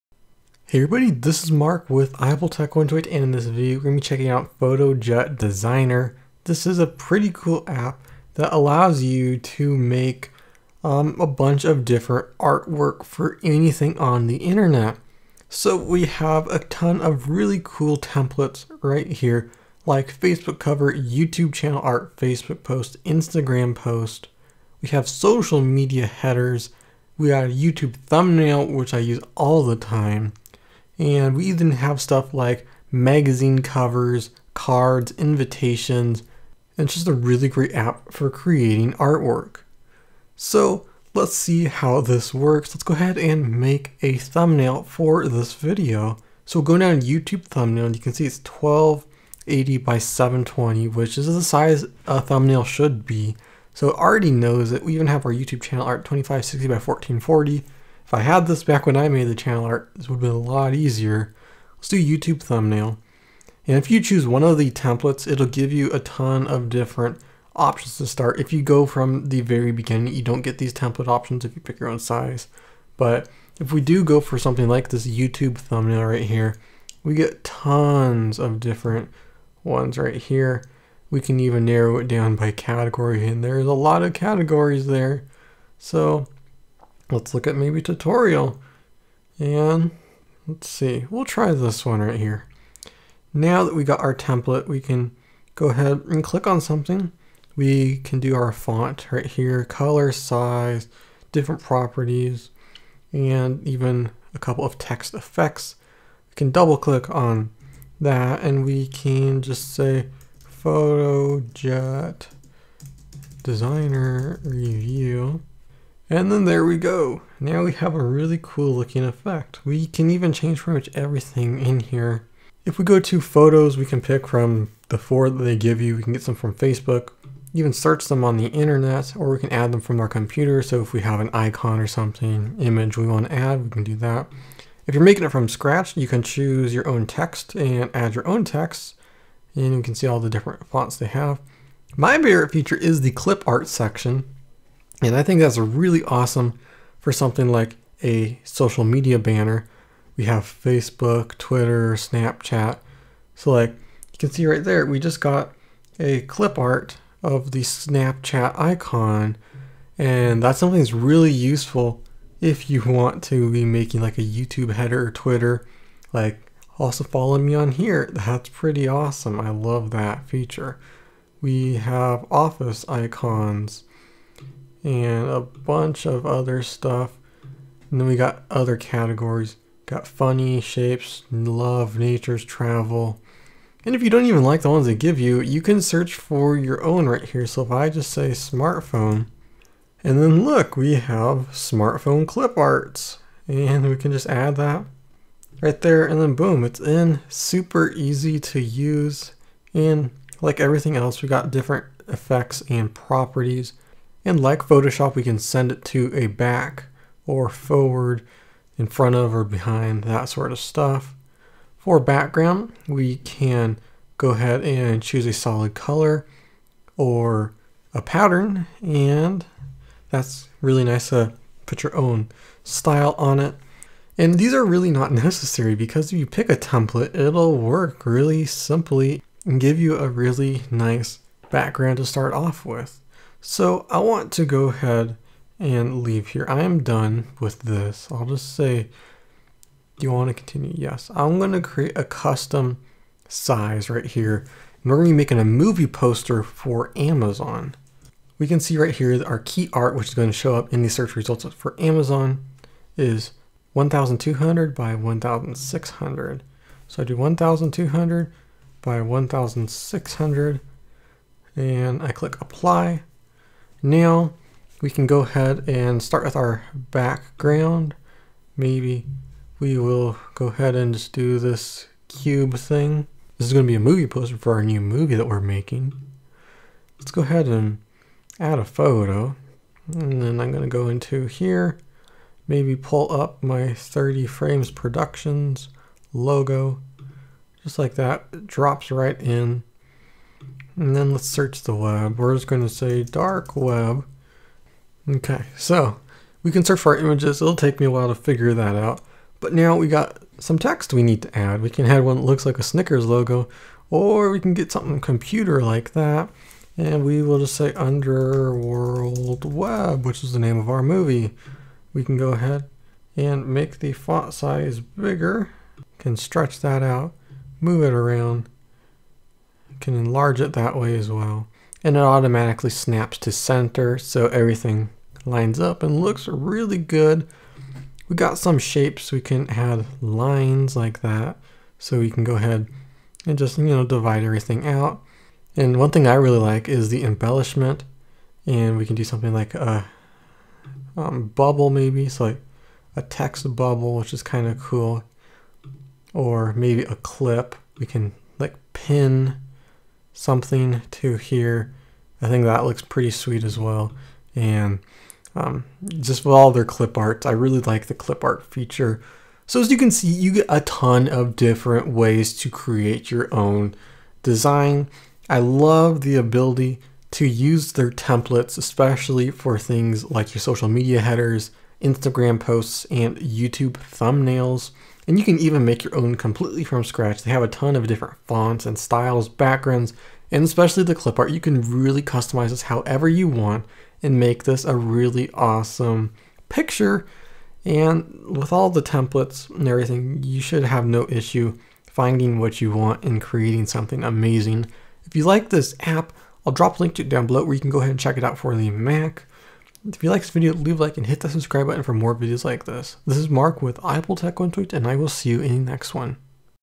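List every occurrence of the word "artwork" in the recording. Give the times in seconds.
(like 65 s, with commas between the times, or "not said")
12 s, 38 s.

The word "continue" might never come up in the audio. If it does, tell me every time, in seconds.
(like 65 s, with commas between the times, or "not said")
240 s.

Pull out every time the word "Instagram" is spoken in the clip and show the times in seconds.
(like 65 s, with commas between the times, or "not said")
23 s, 371 s.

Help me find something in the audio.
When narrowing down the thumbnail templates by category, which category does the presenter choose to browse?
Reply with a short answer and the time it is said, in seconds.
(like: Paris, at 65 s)
tutorial, at 87 s.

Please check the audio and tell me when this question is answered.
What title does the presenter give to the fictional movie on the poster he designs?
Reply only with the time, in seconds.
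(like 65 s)
307 s.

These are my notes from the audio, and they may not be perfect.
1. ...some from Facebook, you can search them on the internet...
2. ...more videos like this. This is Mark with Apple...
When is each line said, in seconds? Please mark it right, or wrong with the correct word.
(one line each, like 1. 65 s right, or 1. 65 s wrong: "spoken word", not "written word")
1. 126 s right
2. 401 s right.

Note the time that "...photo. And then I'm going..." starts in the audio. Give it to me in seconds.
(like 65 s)
278 s.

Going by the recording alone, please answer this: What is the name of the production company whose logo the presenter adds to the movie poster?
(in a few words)
30 Frames Productions.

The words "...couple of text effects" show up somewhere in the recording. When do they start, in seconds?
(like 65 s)
104 s.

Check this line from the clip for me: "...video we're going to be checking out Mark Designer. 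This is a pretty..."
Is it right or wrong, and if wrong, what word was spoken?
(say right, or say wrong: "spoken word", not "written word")
wrong: "FotoJet", not "Mark".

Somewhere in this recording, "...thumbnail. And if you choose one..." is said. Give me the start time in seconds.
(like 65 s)
62 s.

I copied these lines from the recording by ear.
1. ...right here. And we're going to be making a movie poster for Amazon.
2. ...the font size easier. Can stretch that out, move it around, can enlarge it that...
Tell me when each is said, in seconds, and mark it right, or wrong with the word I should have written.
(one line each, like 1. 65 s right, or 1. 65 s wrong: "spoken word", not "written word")
1. 243 s right
2. 313 s wrong: "bigger", not "easier".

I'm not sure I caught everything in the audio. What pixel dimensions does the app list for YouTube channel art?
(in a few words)
2560 by 1440.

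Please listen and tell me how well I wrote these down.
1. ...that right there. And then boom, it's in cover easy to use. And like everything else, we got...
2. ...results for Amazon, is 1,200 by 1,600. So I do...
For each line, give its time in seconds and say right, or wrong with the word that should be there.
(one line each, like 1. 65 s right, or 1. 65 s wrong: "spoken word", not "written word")
1. 194 s wrong: "super", not "cover"
2. 251 s right.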